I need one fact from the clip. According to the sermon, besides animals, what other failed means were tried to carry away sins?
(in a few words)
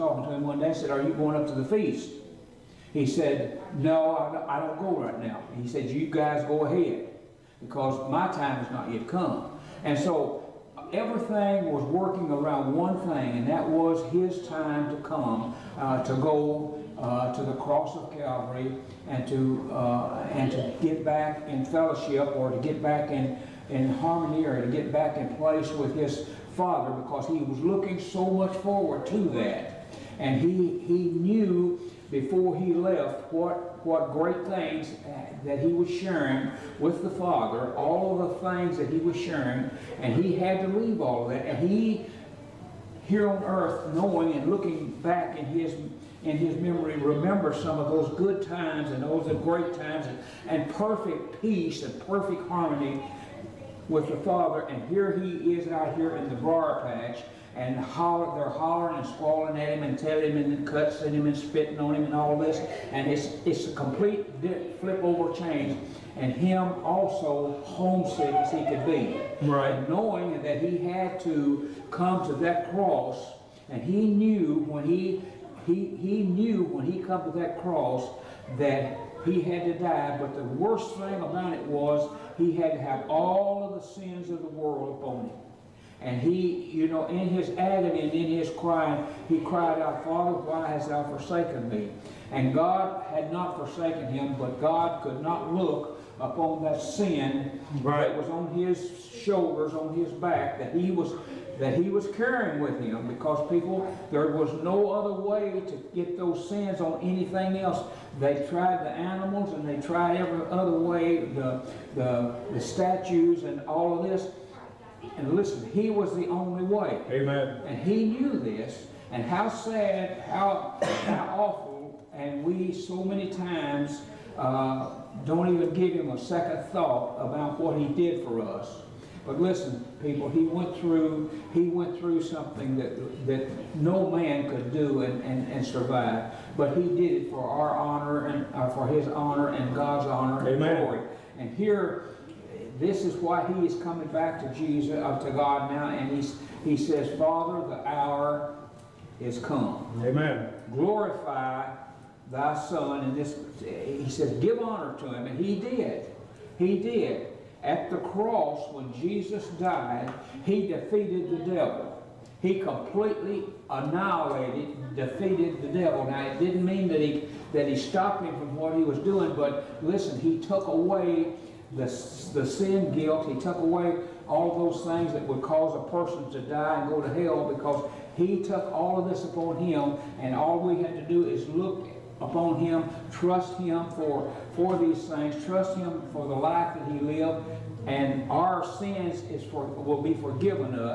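Statues.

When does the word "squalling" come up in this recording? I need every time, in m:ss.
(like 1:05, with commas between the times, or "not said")
0:59.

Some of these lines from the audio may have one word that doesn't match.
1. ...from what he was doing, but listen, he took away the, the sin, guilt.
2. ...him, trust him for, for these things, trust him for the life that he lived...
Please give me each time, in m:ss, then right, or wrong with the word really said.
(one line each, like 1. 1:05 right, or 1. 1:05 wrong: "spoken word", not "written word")
1. 2:48 right
2. 3:02 right.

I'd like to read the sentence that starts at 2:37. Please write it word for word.
At the cross, when Jesus died, he defeated the devil.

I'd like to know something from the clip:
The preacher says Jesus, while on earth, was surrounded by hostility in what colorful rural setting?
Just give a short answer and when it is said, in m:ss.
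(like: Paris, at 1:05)
Briar patch, at 0:56.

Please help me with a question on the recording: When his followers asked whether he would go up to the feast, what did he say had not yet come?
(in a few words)
My time.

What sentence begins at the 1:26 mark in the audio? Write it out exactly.
And he, you know, in his agony and in his crying, he cried out, Father, why hast thou forsaken me?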